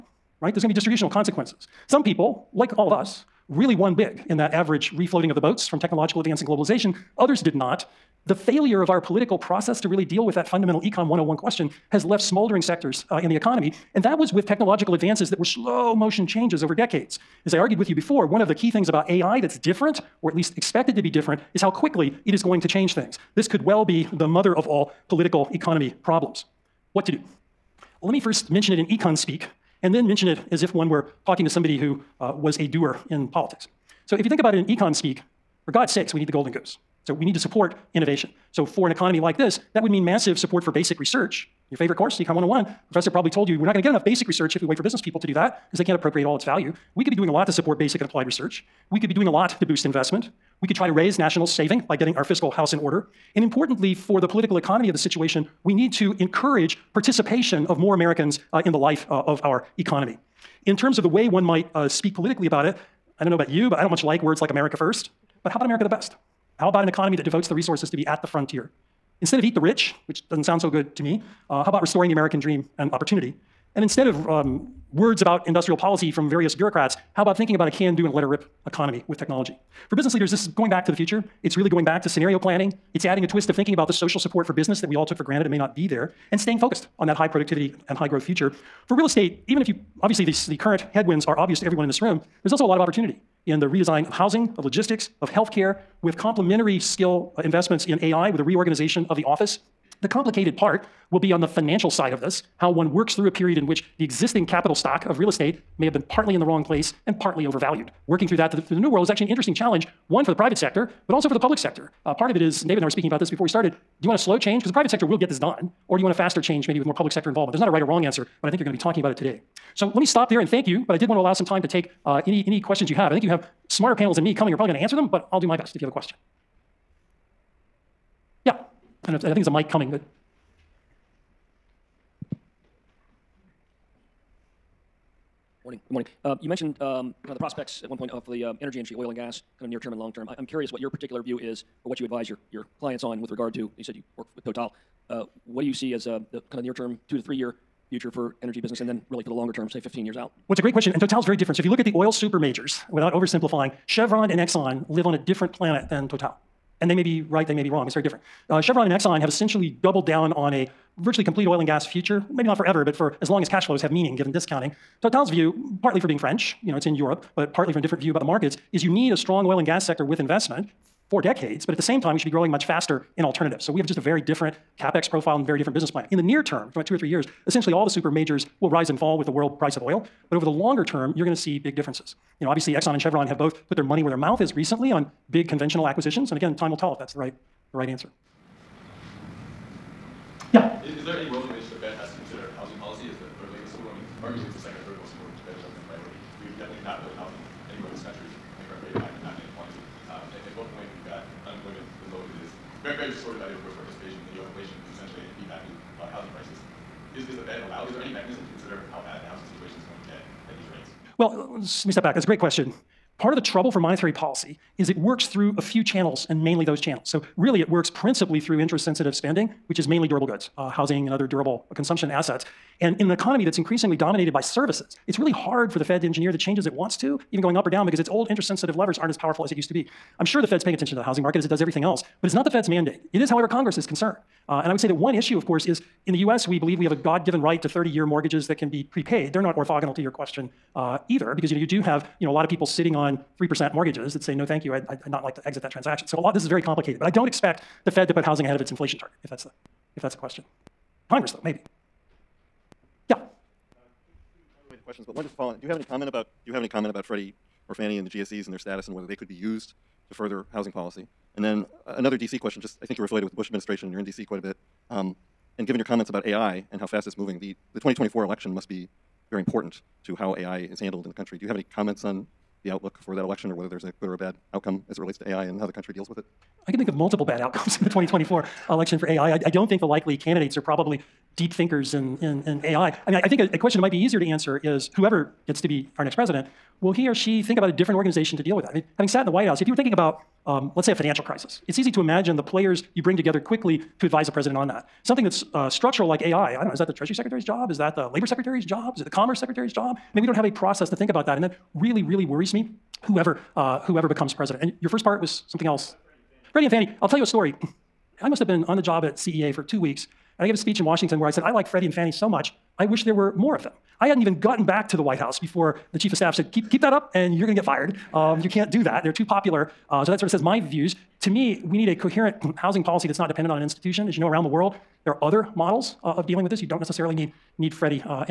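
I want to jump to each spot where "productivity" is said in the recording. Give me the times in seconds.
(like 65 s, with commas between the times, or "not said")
87 s.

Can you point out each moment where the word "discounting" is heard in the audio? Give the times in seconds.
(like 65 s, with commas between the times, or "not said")
164 s.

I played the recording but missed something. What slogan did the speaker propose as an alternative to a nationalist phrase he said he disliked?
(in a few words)
America the best.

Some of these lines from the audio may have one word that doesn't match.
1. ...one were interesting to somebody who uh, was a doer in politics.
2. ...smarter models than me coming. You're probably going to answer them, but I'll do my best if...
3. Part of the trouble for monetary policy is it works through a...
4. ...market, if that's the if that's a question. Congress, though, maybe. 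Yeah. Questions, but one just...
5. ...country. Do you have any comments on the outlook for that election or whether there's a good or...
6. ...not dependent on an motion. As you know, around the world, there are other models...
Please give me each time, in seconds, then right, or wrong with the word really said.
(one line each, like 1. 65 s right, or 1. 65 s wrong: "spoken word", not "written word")
1. 30 s wrong: "talking", not "interesting"
2. 123 s wrong: "panels", not "models"
3. 213 s right
4. 248 s wrong: "target", not "market"
5. 271 s right
6. 323 s wrong: "institution", not "motion".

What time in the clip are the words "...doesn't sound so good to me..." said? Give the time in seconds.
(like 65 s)
70 s.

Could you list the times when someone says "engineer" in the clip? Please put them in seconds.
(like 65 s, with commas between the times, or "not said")
226 s.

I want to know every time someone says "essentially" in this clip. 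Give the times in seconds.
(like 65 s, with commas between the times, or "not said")
159 s, 177 s.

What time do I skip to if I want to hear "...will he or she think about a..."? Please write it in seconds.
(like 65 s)
286 s.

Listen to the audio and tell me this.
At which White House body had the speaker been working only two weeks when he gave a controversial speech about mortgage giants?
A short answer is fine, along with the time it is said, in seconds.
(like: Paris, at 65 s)
CEA, at 309 s.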